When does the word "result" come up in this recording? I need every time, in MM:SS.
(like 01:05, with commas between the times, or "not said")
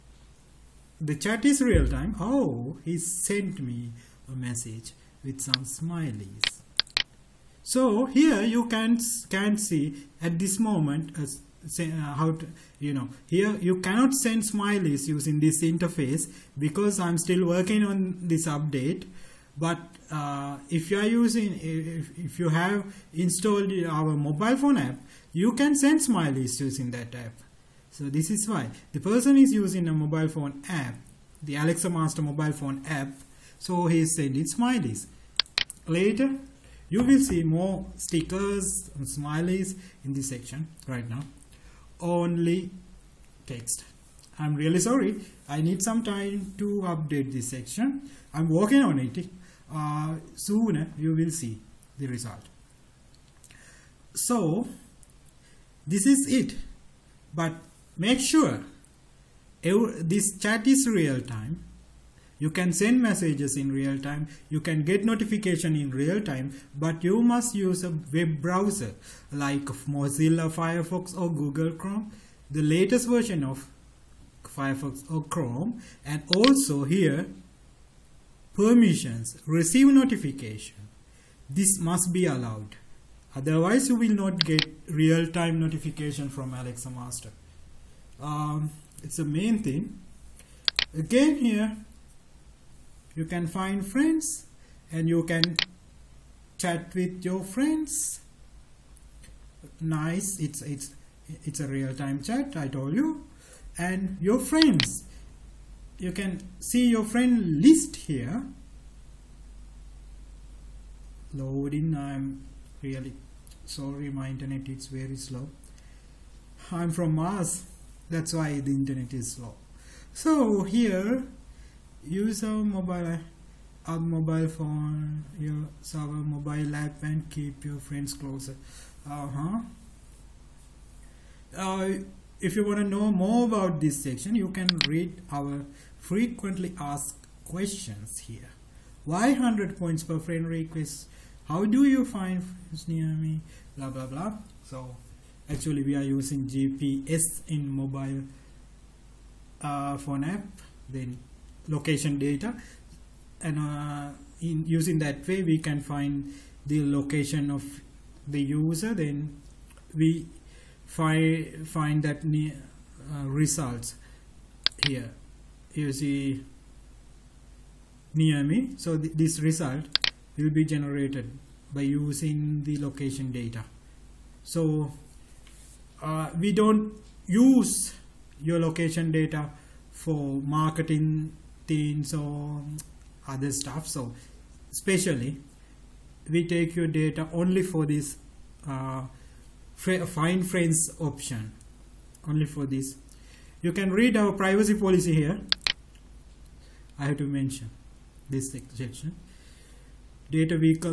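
00:52, 02:43, 02:49.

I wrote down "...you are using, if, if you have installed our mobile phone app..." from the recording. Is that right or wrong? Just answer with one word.
right.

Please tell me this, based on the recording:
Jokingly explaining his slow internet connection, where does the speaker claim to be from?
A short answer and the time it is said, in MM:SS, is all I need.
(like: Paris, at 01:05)
Mars, at 01:56.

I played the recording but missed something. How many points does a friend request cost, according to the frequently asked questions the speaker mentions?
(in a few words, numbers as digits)
100.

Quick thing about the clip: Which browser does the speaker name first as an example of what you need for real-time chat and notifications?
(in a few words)
Mozilla Firefox.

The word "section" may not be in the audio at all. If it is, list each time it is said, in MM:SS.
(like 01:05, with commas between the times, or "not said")
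00:40, 00:47, 02:14, 03:18.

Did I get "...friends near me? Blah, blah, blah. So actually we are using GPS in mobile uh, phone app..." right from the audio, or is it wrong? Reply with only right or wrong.
right.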